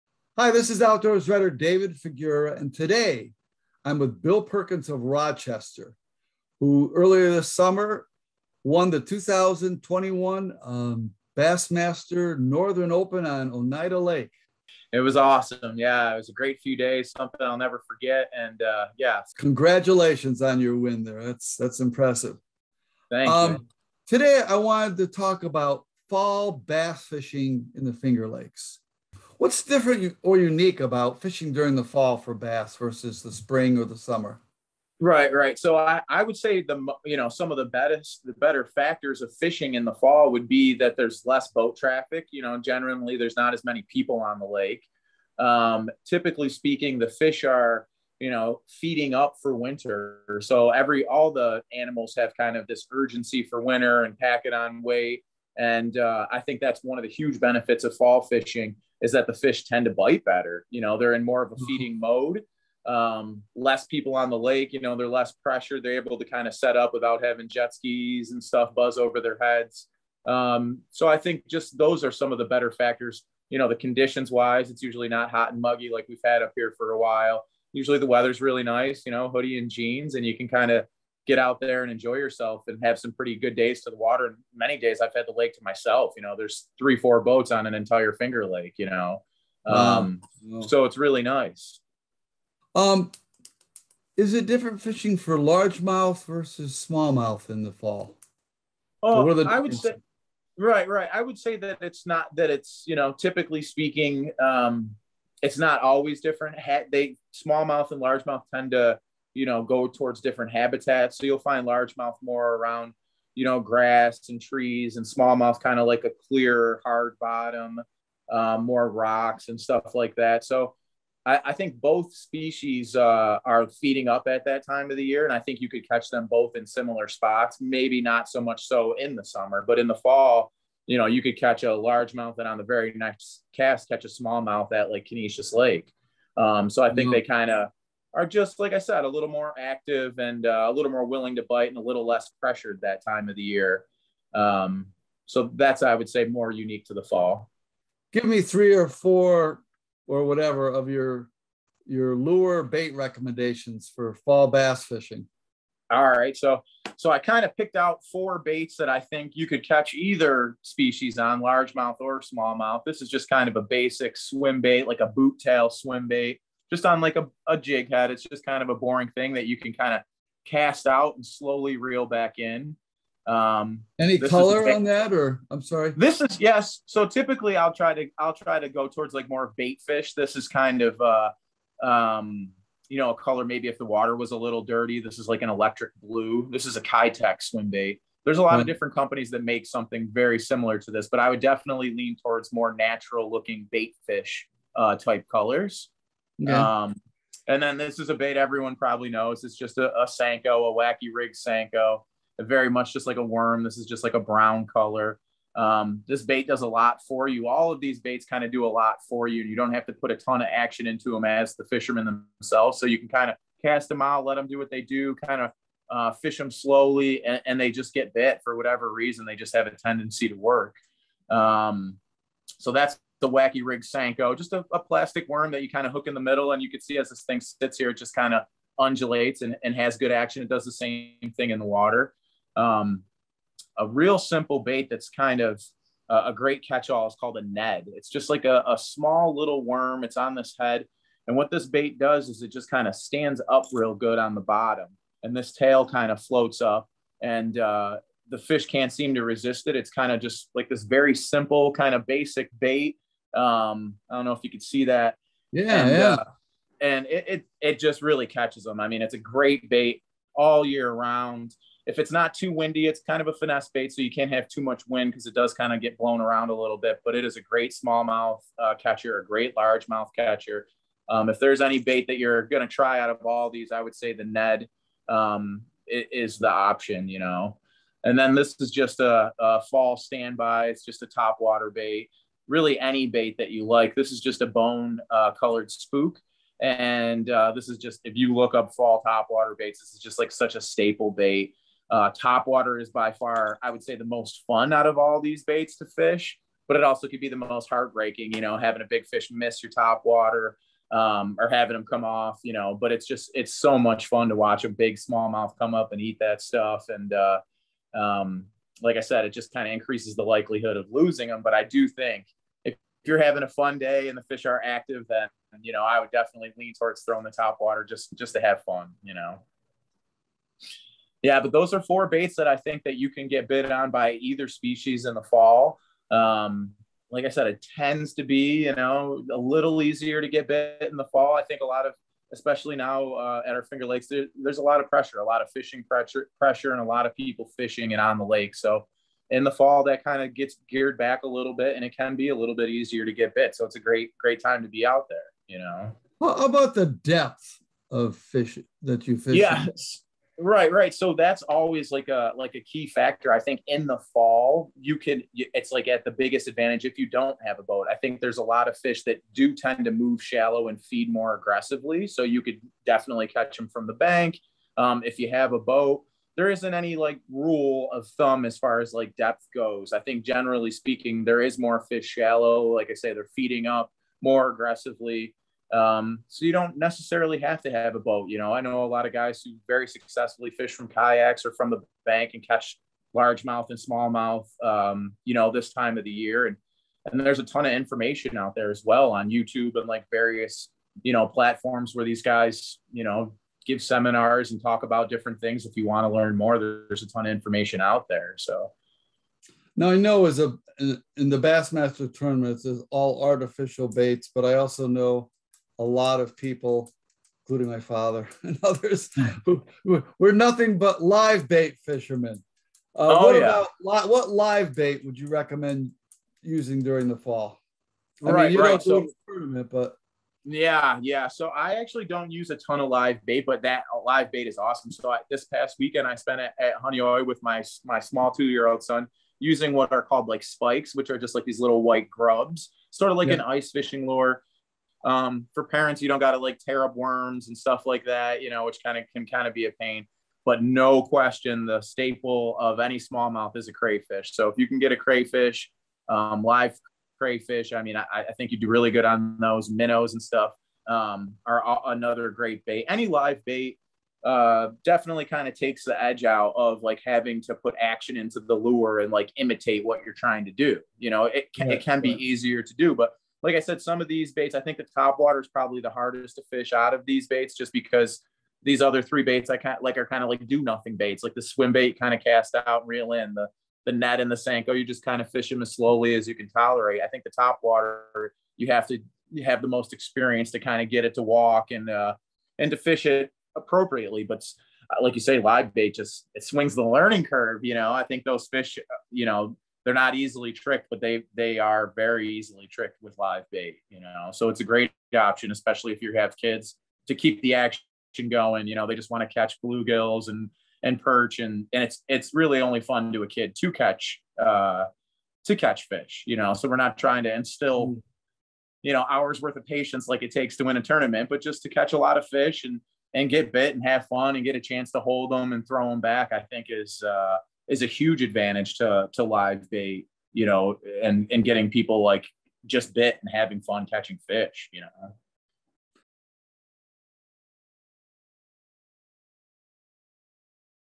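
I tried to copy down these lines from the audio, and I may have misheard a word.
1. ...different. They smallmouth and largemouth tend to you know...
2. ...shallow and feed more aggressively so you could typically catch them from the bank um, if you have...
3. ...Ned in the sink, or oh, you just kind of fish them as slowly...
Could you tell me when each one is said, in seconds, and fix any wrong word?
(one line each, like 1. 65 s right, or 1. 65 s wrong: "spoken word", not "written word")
1. 106 s right
2. 360 s wrong: "definitely", not "typically"
3. 473 s right.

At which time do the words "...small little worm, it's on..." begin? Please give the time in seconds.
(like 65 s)
238 s.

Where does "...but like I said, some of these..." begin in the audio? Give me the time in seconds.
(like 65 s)
462 s.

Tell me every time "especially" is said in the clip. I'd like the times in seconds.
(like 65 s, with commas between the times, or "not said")
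332 s, 495 s.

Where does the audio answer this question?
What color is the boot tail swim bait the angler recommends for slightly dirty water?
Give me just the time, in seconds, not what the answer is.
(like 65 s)
185 s.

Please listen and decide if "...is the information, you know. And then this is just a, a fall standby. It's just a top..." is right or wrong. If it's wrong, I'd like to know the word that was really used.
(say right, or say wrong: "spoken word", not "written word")
wrong: "option", not "information".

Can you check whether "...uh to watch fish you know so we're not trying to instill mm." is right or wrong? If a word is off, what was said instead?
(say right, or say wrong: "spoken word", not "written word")
wrong: "catch", not "watch".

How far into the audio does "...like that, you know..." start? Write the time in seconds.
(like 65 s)
437 s.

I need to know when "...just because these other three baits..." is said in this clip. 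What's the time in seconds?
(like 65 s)
467 s.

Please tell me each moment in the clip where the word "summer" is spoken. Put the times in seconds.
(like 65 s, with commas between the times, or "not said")
7 s, 33 s, 129 s.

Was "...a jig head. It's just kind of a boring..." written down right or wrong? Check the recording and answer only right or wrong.
right.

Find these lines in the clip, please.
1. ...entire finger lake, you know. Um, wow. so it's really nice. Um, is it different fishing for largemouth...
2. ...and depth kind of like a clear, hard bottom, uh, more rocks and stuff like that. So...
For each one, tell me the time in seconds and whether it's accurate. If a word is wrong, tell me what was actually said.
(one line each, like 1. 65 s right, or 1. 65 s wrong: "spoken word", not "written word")
1. 87 s right
2. 114 s wrong: "smallmouth", not "depth".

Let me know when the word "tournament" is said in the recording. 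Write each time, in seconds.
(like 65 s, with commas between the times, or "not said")
402 s, 419 s, 510 s.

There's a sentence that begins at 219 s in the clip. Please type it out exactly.
They just have a tendency to work.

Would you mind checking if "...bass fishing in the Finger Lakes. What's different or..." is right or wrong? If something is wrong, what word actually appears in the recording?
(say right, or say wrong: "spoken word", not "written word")
right.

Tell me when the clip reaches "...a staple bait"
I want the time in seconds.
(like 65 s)
290 s.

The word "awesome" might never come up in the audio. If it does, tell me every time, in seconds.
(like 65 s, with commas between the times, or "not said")
15 s, 424 s.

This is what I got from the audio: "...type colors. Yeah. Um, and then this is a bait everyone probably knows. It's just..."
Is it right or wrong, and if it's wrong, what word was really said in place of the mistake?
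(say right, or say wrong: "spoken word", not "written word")
right.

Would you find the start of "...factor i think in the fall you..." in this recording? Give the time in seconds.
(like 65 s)
352 s.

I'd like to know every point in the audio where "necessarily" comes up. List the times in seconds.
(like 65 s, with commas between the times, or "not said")
376 s.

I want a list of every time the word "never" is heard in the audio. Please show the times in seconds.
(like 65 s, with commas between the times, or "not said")
17 s.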